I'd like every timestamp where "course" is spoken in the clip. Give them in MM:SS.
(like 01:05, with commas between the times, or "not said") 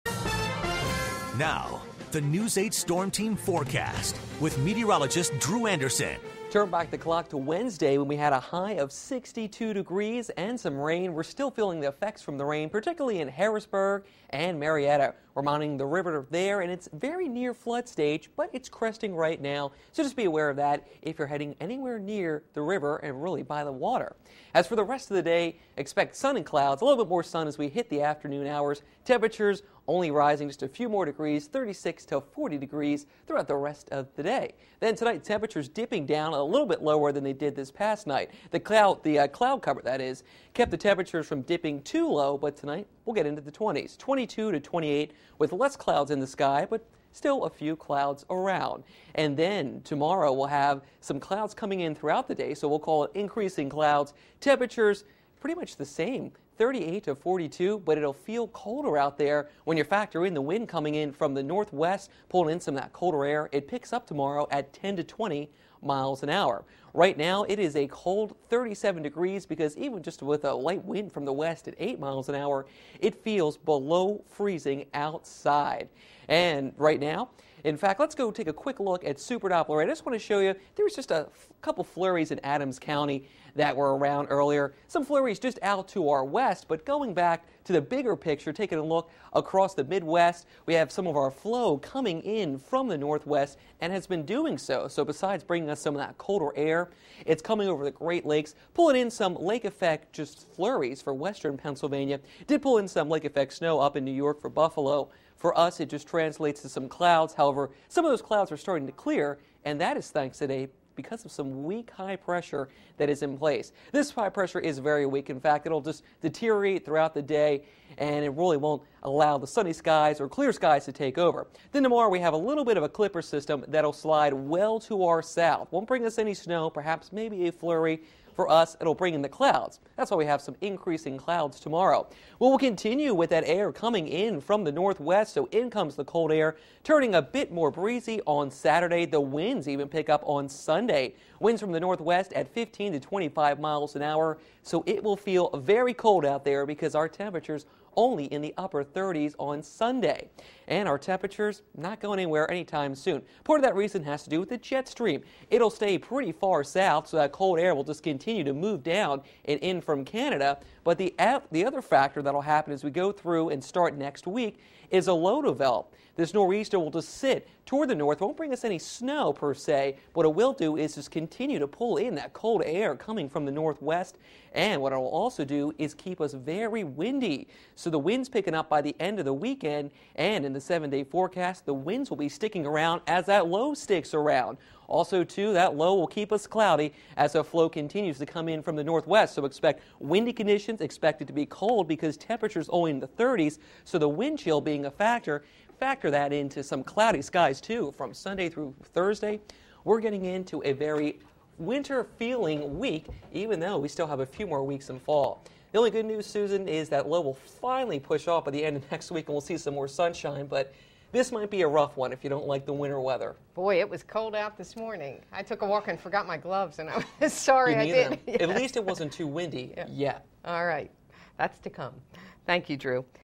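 not said.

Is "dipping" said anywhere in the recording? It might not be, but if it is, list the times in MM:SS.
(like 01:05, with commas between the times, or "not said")
00:35, 00:41.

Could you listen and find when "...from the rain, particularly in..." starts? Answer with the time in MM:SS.
00:12.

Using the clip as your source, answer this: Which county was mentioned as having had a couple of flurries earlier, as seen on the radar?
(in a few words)
Adams County.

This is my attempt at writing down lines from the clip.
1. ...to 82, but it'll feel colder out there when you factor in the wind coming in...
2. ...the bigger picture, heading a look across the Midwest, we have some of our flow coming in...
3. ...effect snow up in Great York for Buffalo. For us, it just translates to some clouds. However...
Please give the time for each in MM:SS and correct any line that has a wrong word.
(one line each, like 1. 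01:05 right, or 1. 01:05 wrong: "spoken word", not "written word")
1. 00:57 wrong: "42", not "82"
2. 01:27 wrong: "taking", not "heading"
3. 01:43 wrong: "New", not "Great".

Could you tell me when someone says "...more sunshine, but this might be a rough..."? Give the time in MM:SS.
03:29.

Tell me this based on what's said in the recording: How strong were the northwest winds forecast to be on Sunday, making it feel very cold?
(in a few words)
15 to 25 miles an hour.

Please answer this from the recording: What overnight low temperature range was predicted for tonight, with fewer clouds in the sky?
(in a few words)
22 to 28.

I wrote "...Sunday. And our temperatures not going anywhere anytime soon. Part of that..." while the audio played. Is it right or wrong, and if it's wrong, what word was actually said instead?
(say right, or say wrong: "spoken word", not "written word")
right.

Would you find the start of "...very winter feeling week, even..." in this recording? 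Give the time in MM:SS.
03:20.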